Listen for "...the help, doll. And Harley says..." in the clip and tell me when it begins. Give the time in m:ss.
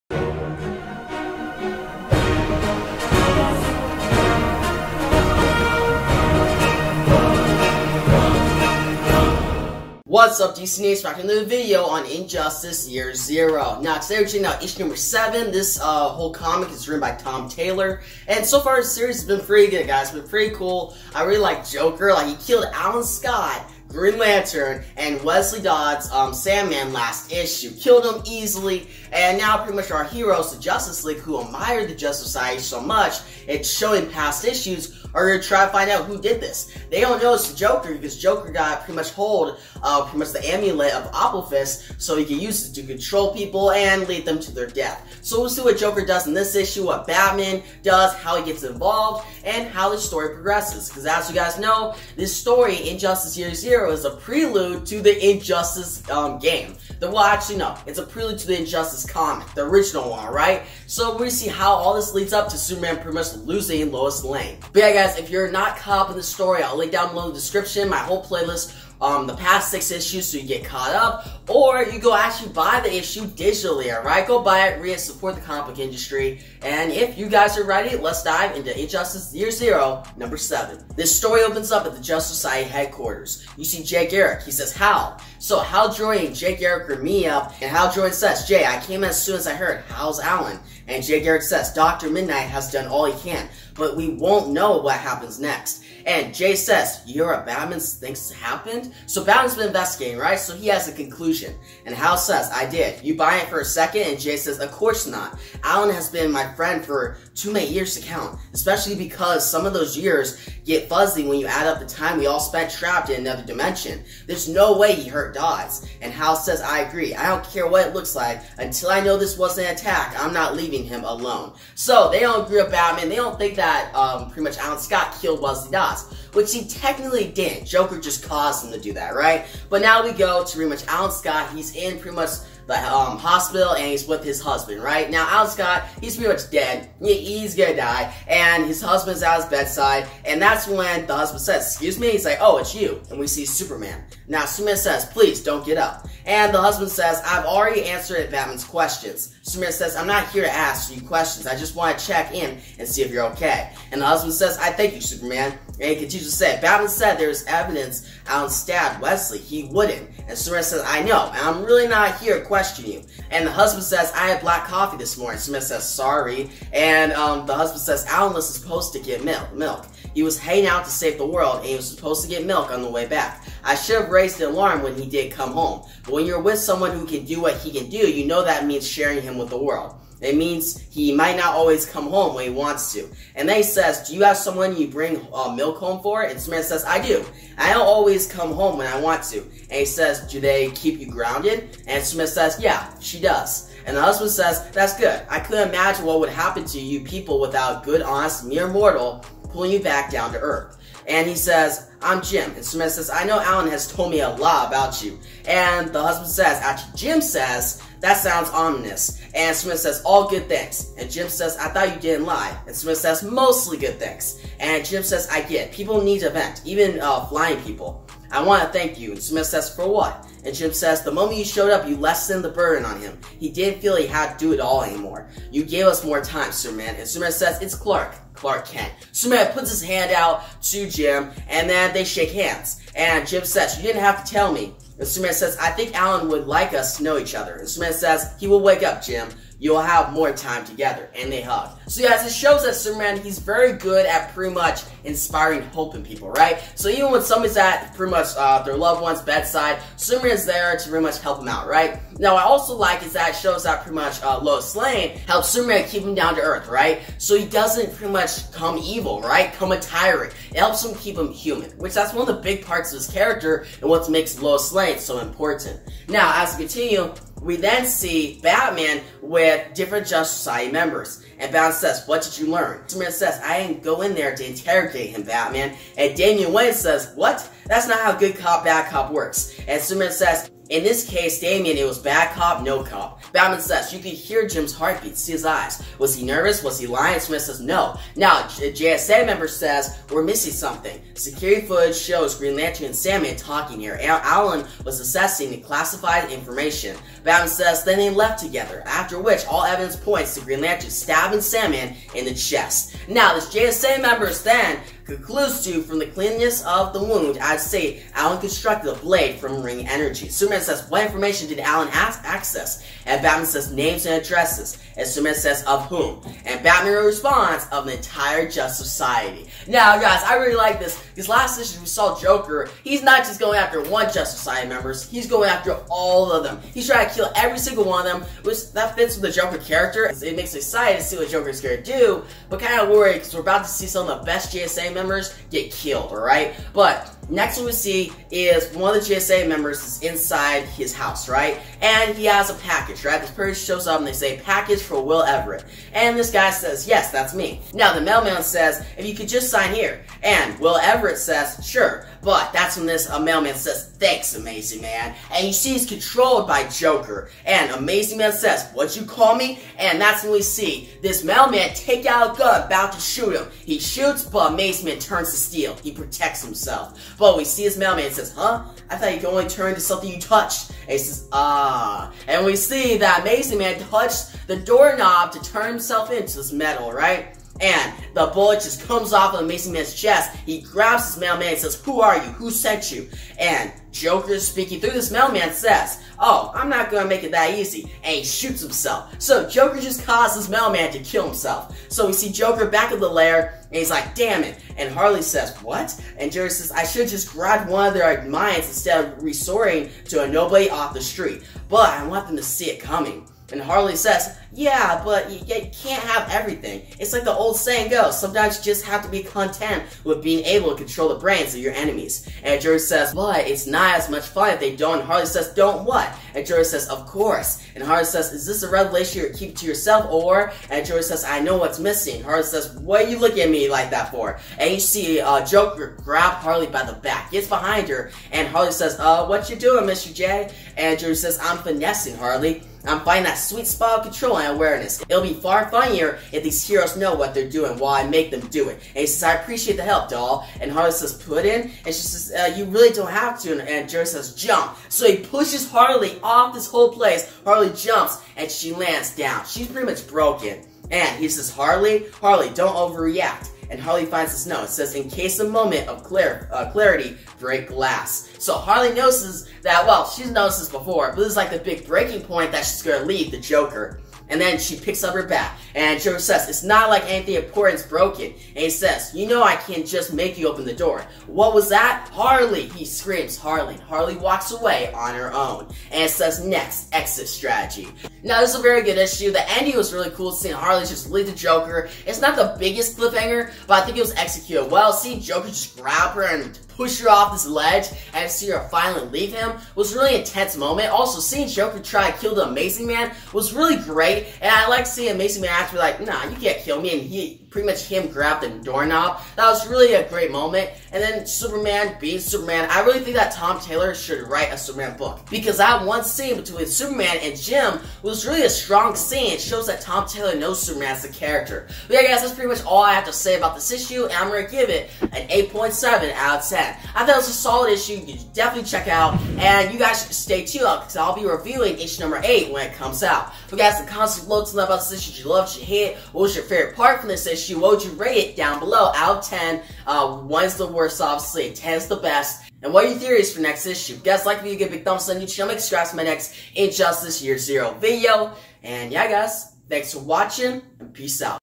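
7:19.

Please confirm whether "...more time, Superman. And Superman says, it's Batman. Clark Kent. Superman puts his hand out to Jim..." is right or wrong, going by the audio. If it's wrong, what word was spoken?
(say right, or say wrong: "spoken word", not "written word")
wrong: "Clark", not "Batman".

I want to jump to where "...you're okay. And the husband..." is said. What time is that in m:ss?
2:33.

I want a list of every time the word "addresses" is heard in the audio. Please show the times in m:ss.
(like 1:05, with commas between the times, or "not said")
5:14.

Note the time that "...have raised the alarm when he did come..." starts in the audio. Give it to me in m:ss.
2:54.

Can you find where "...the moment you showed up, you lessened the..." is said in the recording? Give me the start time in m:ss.
3:41.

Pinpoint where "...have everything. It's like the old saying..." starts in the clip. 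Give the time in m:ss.
6:46.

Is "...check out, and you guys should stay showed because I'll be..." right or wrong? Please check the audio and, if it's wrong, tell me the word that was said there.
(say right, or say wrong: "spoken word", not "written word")
wrong: "tuned", not "showed".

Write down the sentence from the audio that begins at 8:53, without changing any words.
guys like if you give a big thumbs up on YouTube channel.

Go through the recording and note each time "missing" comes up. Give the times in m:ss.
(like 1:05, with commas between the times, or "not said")
4:50, 7:01.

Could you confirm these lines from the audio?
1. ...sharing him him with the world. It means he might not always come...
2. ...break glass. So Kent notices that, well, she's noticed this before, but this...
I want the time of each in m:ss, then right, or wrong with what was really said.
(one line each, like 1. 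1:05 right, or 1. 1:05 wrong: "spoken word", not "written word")
1. 2:58 right
2. 7:37 wrong: "Harley", not "Kent".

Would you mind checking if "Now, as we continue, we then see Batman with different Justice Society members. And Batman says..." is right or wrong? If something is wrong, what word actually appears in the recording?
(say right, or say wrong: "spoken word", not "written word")
right.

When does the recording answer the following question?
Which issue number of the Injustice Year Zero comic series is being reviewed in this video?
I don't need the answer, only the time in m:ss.
0:14.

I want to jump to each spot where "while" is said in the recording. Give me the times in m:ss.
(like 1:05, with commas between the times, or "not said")
7:17.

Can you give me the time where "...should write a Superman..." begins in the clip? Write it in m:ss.
8:23.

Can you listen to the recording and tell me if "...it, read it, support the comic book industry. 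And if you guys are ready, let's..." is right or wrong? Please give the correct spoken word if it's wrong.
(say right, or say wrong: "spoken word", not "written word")
right.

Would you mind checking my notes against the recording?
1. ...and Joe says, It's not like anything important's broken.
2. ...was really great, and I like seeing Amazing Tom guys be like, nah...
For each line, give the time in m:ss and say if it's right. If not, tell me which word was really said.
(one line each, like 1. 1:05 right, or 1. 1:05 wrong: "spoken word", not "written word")
1. 7:45 right
2. 8:13 wrong: "Man", not "Tom".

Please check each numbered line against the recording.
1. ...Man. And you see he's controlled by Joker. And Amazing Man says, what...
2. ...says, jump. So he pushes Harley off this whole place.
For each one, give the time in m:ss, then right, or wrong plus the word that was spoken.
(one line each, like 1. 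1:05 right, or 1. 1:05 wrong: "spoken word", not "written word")
1. 5:54 right
2. 7:24 right.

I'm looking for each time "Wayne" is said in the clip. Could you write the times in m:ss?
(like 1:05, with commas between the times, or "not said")
4:36.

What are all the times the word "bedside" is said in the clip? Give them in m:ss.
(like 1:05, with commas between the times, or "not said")
2:19, 4:09.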